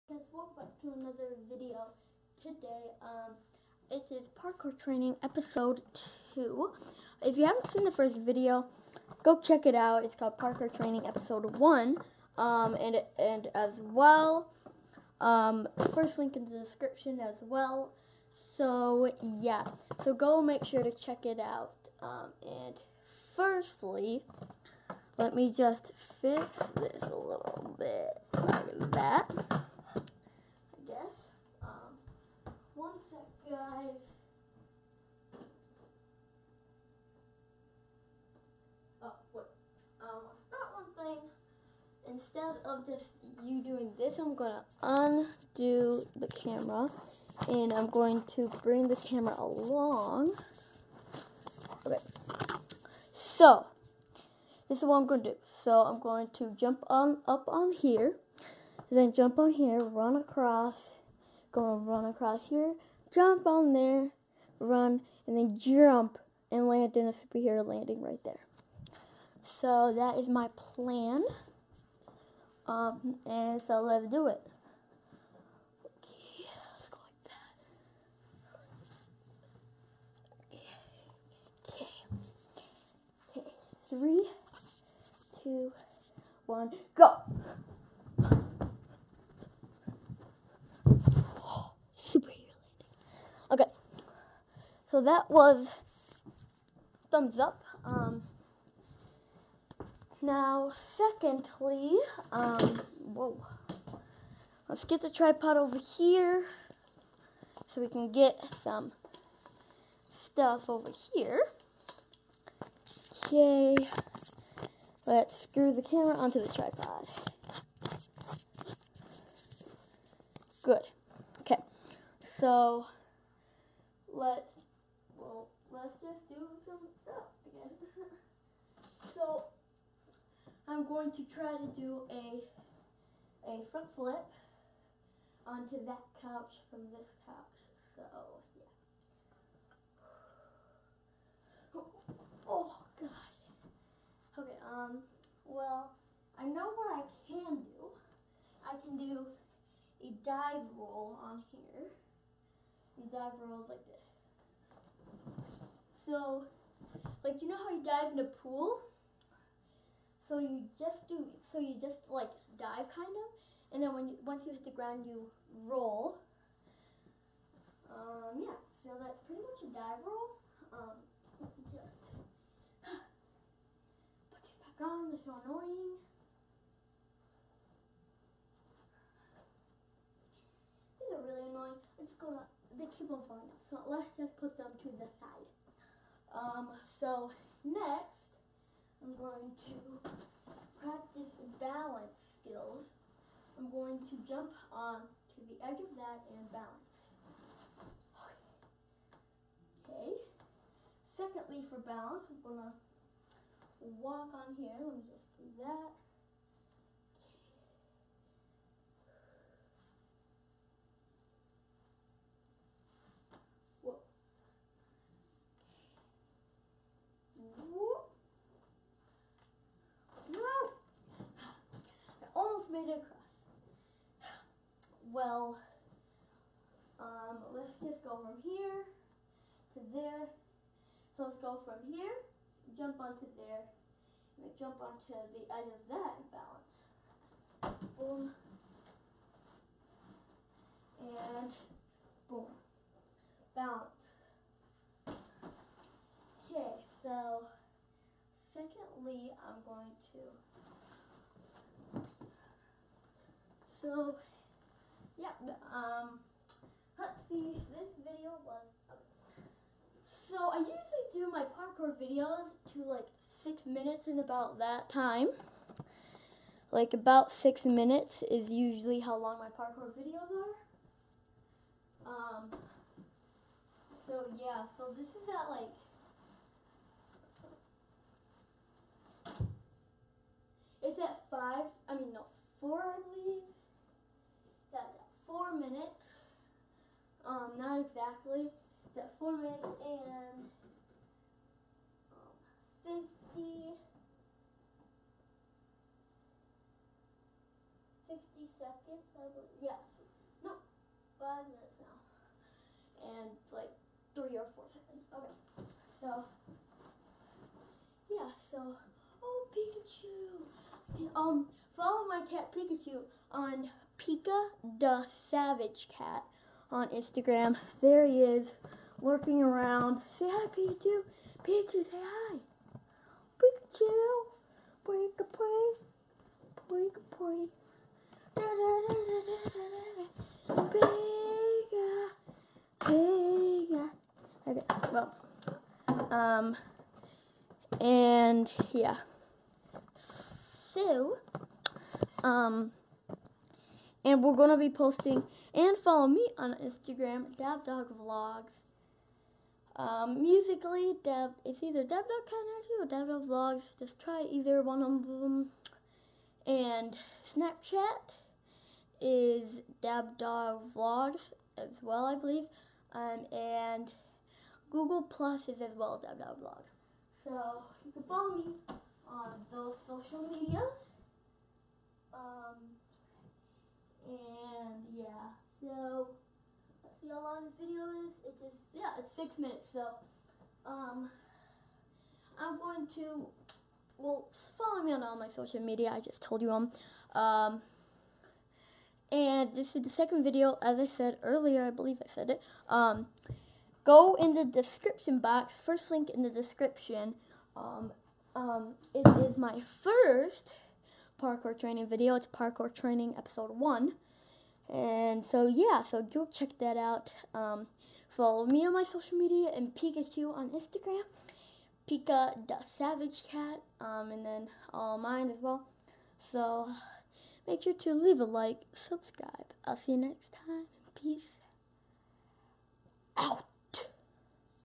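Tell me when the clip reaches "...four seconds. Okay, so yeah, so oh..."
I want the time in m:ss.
5:04.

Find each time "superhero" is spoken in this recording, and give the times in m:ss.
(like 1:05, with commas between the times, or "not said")
1:07, 1:31.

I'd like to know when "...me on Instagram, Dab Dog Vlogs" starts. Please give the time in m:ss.
5:46.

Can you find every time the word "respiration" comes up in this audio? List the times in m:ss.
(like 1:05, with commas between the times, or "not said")
not said.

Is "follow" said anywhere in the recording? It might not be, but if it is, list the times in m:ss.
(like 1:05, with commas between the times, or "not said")
5:11, 5:45, 6:08, 6:24, 6:48.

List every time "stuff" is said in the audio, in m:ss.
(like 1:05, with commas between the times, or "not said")
1:50, 2:07.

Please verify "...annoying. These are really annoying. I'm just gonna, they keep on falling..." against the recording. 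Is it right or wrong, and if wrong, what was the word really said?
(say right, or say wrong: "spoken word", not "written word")
right.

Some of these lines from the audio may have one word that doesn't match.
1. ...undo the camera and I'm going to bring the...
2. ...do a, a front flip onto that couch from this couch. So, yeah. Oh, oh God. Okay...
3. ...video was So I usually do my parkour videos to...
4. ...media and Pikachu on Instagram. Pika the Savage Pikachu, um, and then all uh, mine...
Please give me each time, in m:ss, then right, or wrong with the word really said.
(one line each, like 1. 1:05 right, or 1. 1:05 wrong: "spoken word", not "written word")
1. 0:44 right
2. 2:11 right
3. 4:18 right
4. 6:49 wrong: "Cat", not "Pikachu".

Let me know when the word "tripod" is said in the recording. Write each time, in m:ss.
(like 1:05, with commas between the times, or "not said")
1:45, 1:56.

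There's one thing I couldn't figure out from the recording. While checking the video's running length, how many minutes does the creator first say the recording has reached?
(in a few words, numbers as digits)
5 minutes.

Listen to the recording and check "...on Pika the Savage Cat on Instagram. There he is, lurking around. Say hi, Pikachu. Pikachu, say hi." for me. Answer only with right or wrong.
right.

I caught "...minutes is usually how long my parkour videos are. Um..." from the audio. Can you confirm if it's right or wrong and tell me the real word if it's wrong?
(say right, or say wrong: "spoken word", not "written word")
right.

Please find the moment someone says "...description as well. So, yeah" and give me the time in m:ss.
0:16.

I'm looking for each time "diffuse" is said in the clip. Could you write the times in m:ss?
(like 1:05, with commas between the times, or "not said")
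not said.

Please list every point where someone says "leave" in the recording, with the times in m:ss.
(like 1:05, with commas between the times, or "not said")
6:57.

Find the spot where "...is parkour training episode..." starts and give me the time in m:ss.
0:04.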